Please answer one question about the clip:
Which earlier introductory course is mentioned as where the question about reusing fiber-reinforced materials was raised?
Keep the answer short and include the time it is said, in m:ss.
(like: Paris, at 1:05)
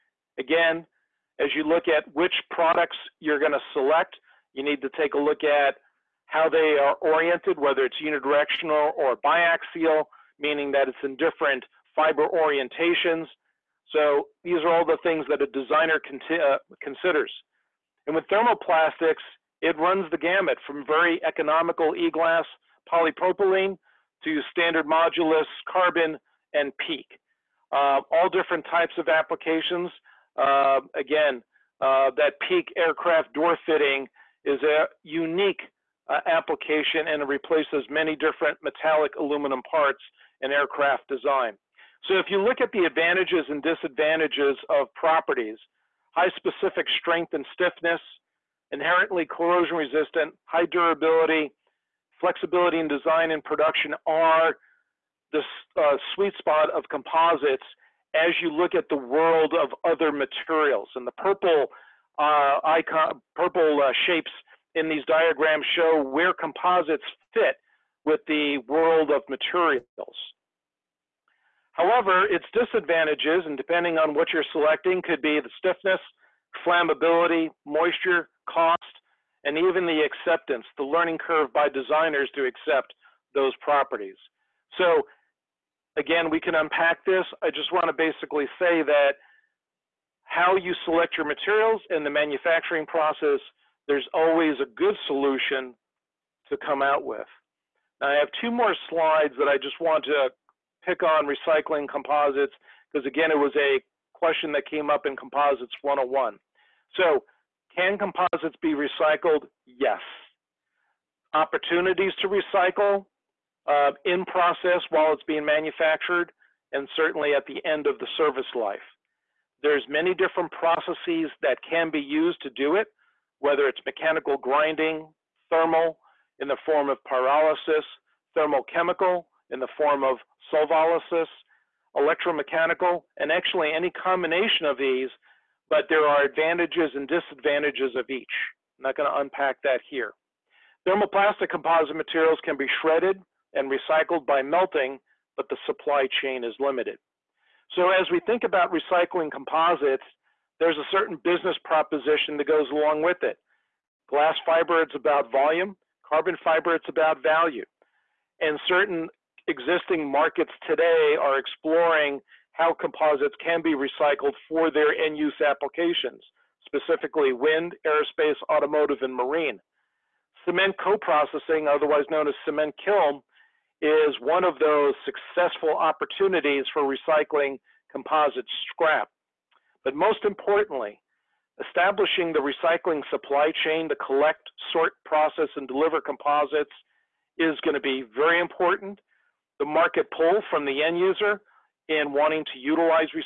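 Composites 101, at 1:45.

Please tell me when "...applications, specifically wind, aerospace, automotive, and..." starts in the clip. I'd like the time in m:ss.
2:45.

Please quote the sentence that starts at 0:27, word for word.
Uh, all different types of applications.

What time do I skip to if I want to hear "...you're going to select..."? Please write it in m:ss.
0:03.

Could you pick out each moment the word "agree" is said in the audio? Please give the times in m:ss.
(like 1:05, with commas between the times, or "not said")
not said.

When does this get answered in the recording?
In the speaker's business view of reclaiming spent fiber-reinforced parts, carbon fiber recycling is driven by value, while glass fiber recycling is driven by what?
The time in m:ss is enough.
2:35.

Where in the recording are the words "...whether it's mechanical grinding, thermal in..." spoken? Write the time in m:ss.
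2:03.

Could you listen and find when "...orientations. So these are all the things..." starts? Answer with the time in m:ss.
0:12.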